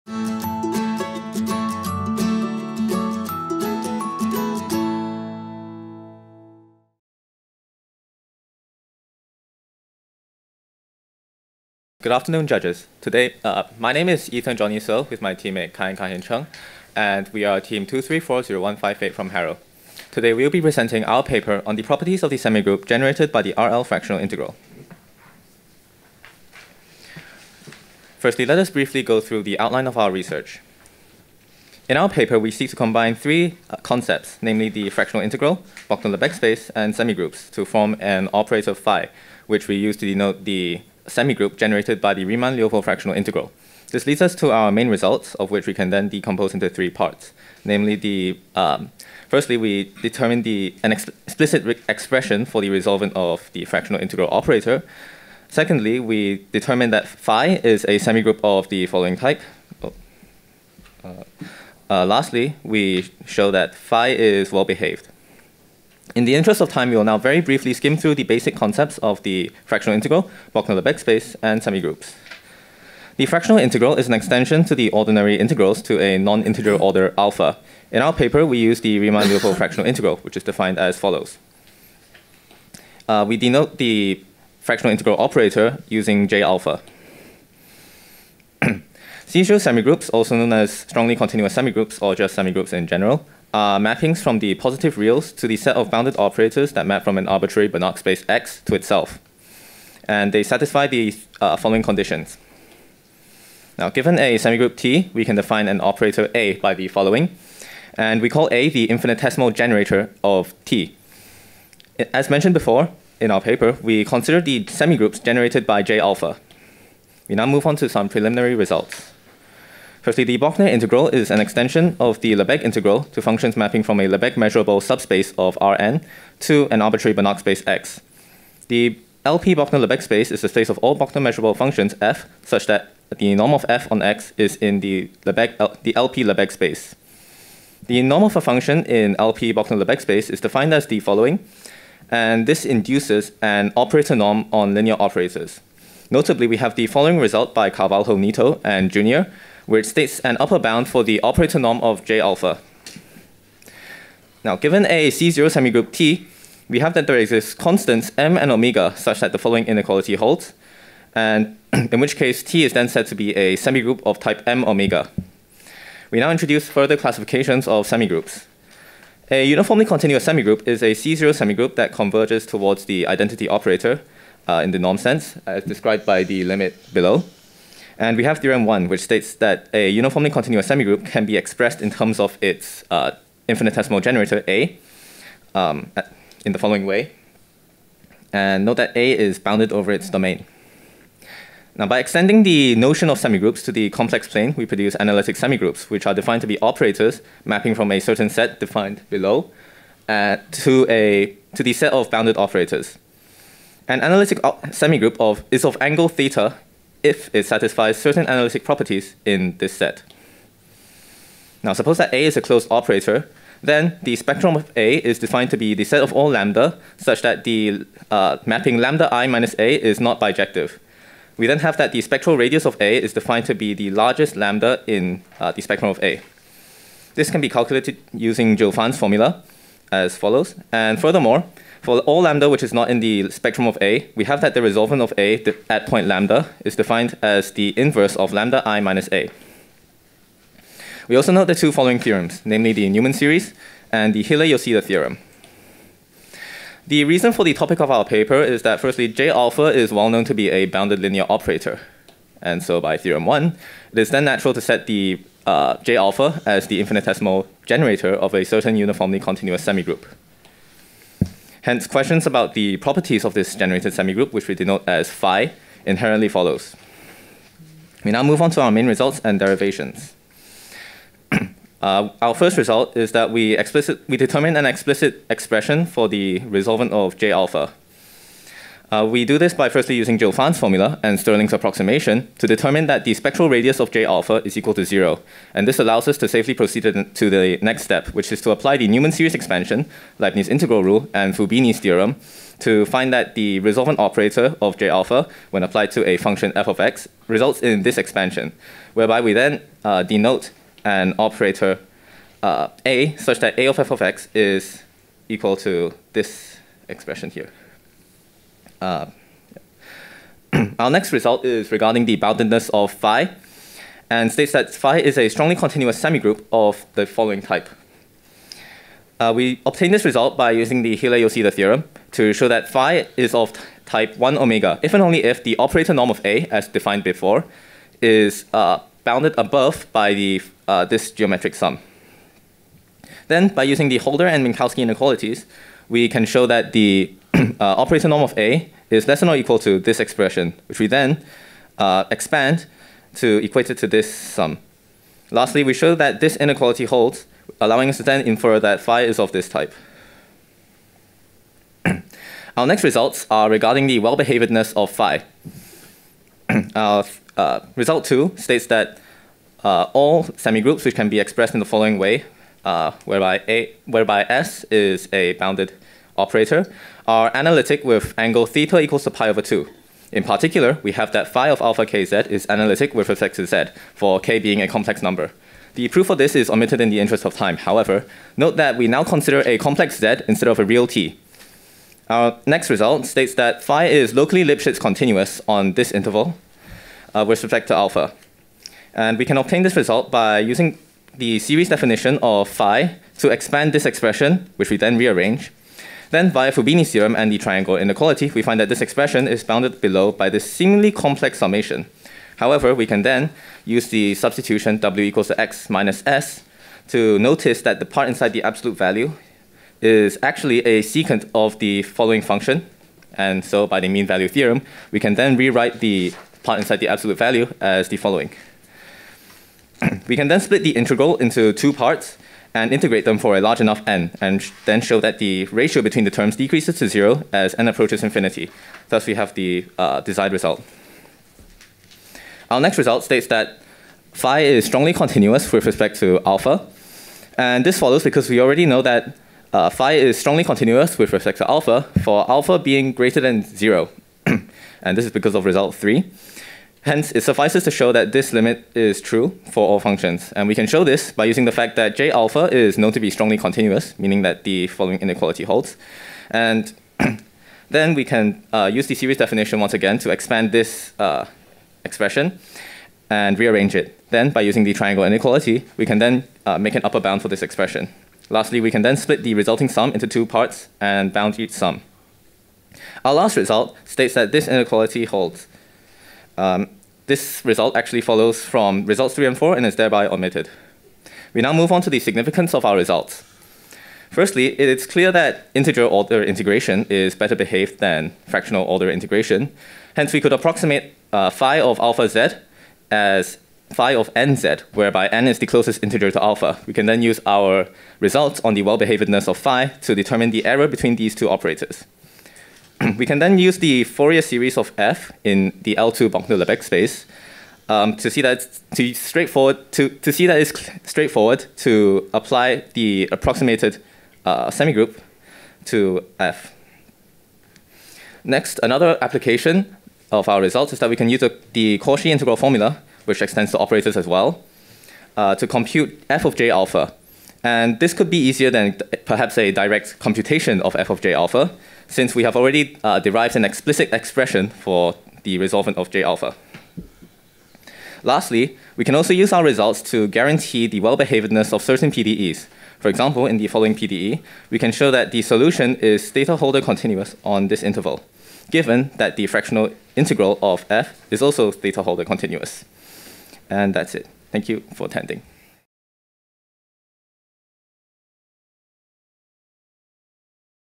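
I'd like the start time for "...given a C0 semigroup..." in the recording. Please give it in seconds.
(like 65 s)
154 s.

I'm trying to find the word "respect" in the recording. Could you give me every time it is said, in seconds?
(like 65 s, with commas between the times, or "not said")
373 s, 387 s, 435 s, 441 s.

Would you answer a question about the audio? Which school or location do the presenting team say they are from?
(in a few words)
Harrow.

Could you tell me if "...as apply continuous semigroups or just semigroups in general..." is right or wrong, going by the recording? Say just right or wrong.
wrong.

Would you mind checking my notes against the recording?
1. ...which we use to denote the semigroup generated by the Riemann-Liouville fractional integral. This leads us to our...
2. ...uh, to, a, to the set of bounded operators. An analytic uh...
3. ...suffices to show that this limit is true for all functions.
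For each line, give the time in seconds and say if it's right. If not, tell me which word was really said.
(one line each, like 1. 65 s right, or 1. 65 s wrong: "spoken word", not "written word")
1. 39 s right
2. 200 s right
3. 447 s right.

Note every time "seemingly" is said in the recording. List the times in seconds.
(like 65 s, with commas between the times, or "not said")
400 s.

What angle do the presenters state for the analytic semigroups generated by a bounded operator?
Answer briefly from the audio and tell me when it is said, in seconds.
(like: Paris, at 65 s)
pi over 2, at 369 s.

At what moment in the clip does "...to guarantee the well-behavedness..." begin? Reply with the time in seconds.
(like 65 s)
539 s.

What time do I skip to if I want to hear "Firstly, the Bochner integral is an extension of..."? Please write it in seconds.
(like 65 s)
120 s.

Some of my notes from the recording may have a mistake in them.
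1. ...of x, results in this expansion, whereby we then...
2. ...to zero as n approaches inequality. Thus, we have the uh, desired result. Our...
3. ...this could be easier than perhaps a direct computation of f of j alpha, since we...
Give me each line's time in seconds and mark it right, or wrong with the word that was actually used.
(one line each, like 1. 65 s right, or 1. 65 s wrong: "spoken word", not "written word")
1. 296 s right
2. 426 s wrong: "infinity", not "inequality"
3. 527 s right.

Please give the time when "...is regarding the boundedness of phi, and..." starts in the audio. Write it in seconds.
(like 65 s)
311 s.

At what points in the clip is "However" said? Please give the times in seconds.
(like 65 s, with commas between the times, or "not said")
377 s, 402 s.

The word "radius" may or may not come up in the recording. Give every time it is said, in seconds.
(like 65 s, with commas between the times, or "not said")
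222 s, 283 s.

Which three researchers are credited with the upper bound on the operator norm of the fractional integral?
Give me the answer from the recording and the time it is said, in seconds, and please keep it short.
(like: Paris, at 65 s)
Carvalho, Neto, and Jr., at 147 s.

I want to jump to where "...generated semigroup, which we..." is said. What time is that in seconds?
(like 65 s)
263 s.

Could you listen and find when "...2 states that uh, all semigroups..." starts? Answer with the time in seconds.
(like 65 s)
358 s.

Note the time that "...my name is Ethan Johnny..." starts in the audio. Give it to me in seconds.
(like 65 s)
13 s.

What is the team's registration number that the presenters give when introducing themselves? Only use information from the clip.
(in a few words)
2340158.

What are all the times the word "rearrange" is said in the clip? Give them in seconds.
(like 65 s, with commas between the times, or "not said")
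394 s, 463 s.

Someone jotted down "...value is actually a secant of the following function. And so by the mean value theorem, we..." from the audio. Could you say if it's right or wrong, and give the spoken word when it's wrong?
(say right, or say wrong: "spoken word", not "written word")
right.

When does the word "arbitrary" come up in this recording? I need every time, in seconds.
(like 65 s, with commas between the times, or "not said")
97 s, 126 s.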